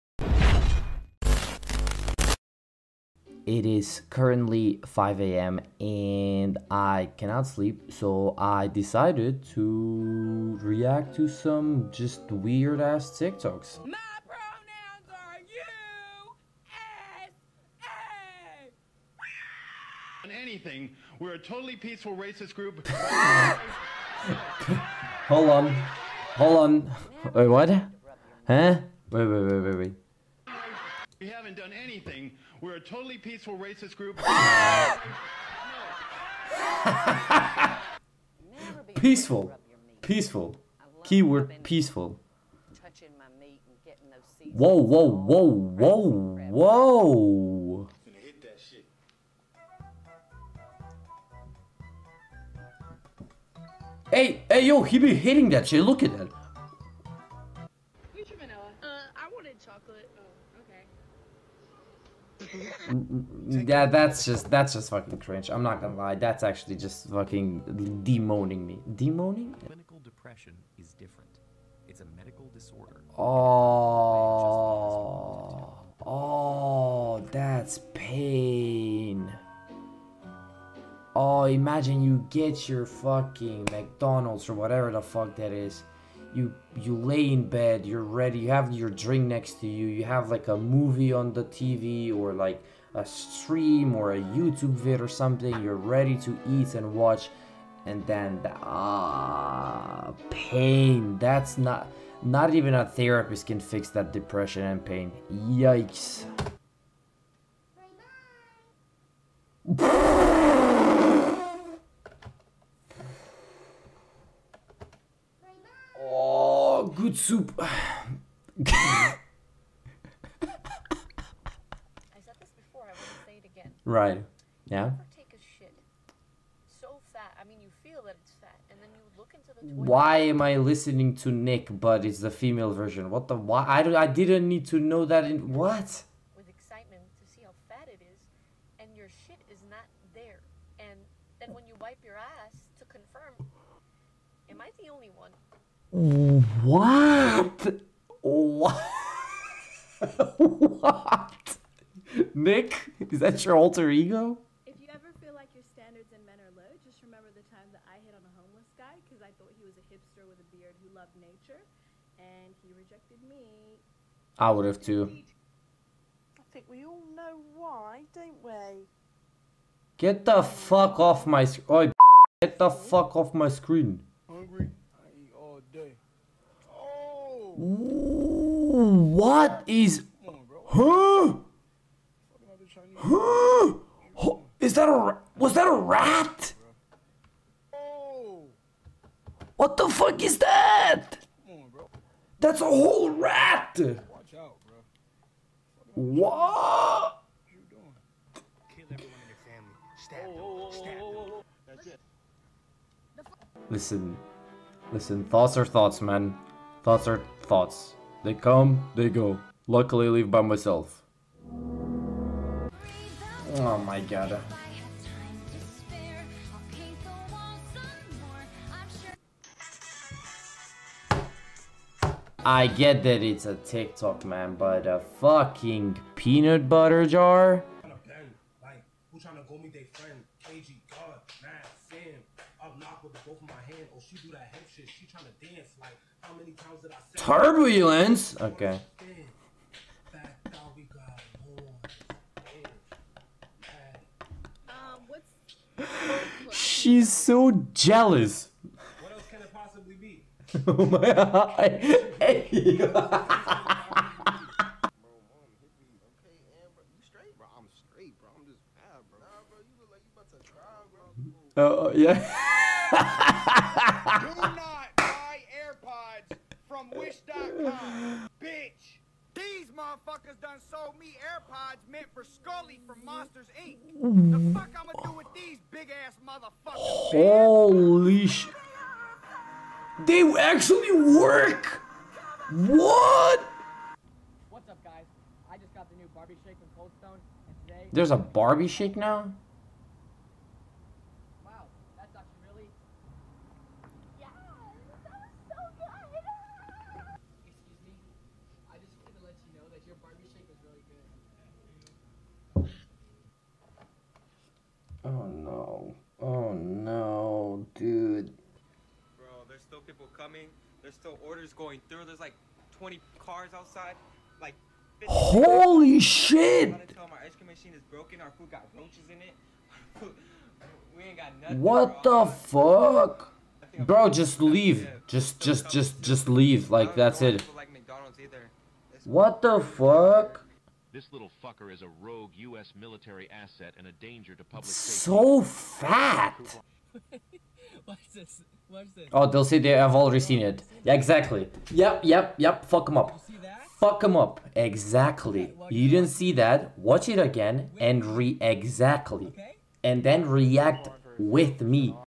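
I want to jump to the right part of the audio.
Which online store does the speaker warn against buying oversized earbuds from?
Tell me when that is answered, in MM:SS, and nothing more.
04:26.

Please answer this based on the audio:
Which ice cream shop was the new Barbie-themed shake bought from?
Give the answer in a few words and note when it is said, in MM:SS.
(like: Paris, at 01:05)
Coldstone, at 04:46.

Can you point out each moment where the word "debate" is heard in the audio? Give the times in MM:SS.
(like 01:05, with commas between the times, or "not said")
not said.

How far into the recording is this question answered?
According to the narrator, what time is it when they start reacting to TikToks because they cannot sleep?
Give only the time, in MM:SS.
00:04.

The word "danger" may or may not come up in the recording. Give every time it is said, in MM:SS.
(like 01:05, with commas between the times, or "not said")
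05:33.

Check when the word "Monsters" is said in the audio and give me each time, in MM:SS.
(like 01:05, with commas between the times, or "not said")
04:33.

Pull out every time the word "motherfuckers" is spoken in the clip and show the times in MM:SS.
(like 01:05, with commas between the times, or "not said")
04:29, 04:36.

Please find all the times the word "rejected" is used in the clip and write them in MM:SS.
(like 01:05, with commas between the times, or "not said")
02:42.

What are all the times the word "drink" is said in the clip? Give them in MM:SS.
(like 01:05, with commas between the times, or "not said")
01:28.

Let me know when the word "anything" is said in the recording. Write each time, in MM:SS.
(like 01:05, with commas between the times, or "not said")
00:20, 00:31.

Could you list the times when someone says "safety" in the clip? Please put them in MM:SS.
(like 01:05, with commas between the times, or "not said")
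05:34.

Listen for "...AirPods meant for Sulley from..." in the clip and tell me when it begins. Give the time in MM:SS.
04:31.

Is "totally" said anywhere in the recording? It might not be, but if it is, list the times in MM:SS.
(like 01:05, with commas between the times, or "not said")
00:21, 00:32.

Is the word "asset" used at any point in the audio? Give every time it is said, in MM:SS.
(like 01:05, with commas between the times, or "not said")
05:33.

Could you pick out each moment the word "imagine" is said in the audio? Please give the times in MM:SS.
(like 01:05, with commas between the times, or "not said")
01:21.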